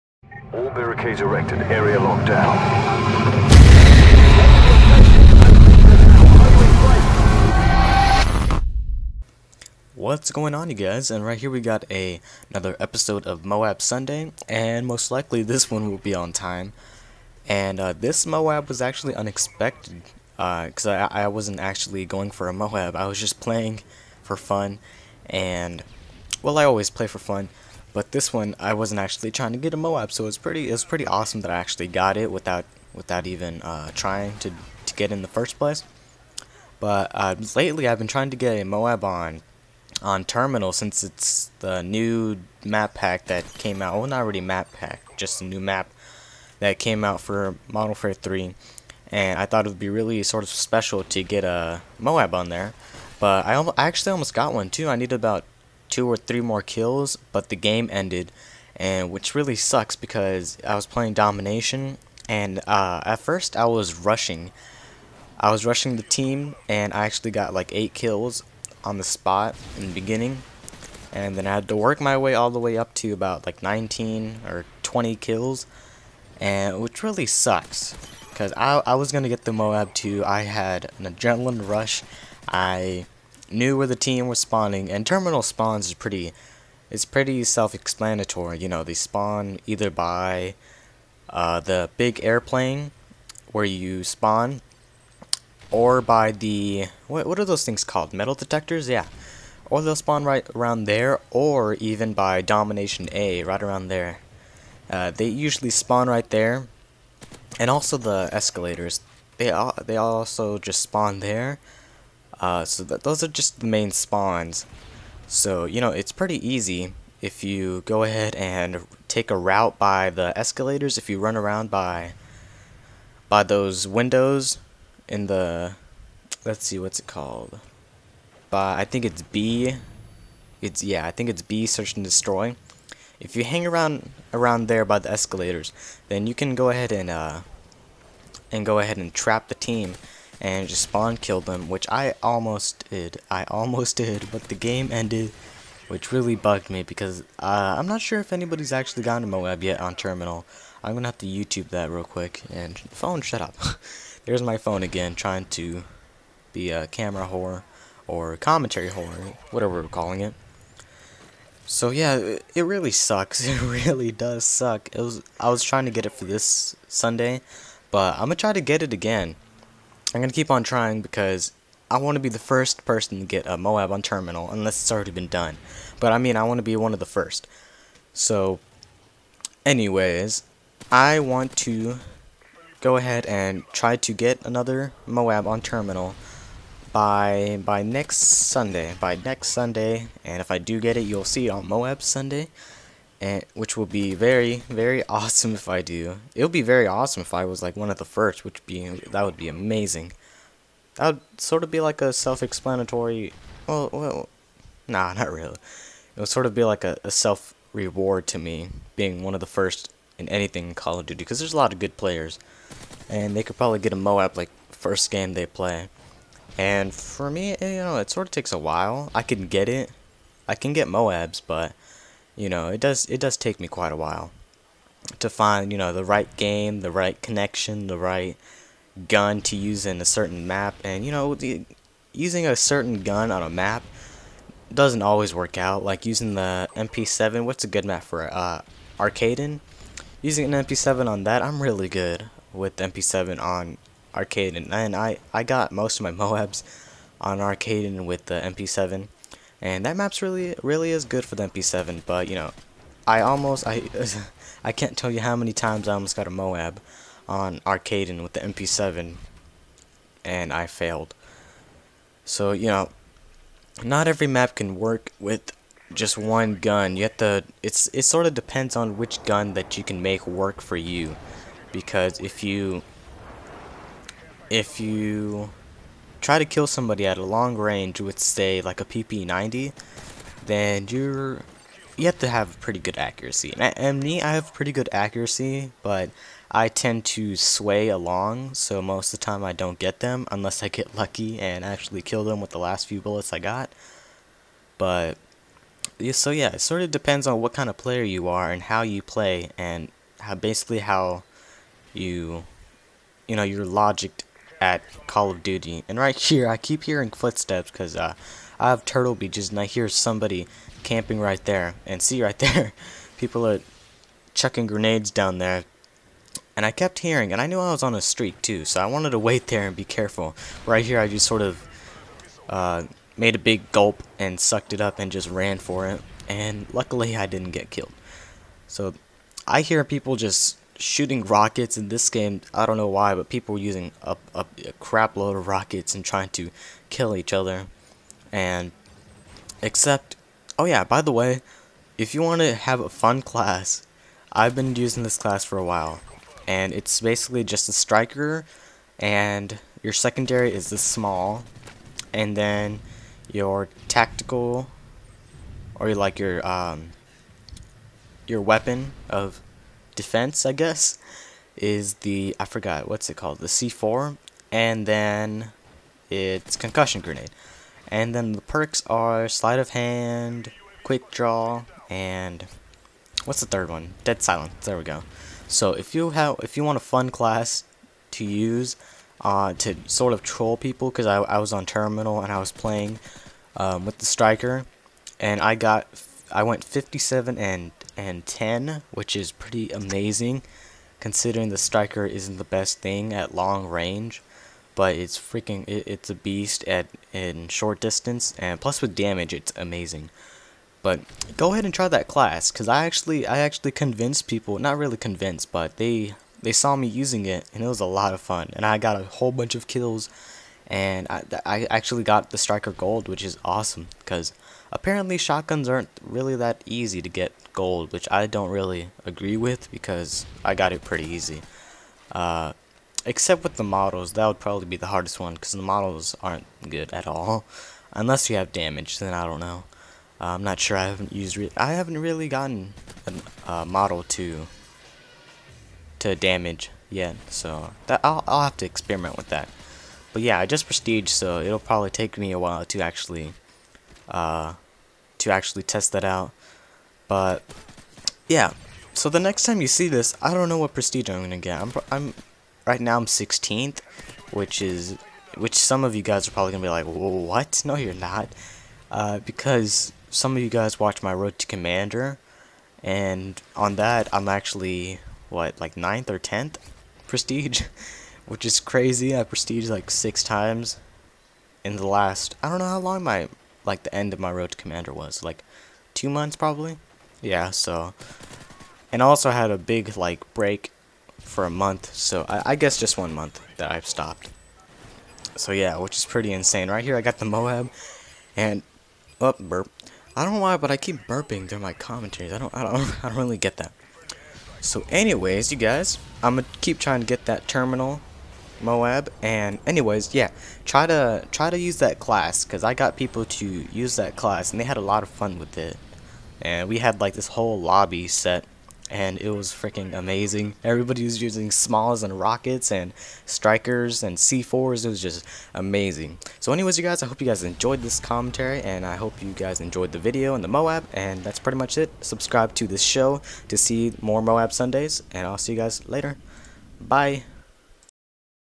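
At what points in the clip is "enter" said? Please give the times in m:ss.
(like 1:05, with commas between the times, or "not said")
not said.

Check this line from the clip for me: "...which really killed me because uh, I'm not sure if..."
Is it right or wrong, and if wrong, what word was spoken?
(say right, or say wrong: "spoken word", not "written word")
wrong: "bugged", not "killed".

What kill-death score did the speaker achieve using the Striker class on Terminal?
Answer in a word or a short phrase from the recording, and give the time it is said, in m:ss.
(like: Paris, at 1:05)
57 and 10, at 6:26.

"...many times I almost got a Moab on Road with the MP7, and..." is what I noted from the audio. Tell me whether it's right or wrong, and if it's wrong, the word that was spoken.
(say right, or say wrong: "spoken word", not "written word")
wrong: "Arcaden", not "Road".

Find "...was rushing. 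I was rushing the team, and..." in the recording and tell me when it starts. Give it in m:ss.
1:03.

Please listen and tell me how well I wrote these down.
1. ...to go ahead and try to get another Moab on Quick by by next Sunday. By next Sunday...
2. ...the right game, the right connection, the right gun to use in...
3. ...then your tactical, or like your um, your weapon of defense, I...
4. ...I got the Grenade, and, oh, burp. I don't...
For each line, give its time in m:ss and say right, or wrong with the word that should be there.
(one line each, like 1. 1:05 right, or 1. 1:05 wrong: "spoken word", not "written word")
1. 3:01 wrong: "Terminal", not "Quick"
2. 3:45 right
3. 5:52 right
4. 8:06 wrong: "Moab", not "Grenade".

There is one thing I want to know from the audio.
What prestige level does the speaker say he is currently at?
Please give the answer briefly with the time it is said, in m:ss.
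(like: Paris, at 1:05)
16th, at 7:33.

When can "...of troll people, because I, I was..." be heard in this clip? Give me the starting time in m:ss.
6:20.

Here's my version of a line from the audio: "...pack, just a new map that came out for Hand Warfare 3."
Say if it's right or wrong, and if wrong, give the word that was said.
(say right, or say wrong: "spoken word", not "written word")
wrong: "Modern", not "Hand".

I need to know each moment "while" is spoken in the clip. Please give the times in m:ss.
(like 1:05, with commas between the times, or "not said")
3:38, 3:43, 5:45, 7:22.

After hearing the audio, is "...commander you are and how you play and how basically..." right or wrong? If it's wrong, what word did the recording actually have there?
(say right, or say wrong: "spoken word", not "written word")
wrong: "player", not "commander".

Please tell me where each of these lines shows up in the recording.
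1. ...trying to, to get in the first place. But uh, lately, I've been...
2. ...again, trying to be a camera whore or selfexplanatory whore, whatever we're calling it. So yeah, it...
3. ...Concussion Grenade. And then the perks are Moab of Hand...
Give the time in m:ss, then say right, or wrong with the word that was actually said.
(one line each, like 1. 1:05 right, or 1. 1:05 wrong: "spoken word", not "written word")
1. 0:33 right
2. 2:34 wrong: "commentary", not "selfexplanatory"
3. 6:06 wrong: "Sleight", not "Moab".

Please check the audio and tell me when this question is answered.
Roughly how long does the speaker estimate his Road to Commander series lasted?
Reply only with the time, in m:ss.
7:55.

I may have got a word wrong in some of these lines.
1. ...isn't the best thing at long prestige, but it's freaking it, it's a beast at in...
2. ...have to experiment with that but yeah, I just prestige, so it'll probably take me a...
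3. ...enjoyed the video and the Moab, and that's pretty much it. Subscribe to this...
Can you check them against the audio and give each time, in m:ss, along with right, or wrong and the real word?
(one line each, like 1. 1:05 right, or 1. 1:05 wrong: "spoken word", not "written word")
1. 6:32 wrong: "range", not "prestige"
2. 7:18 right
3. 8:39 right.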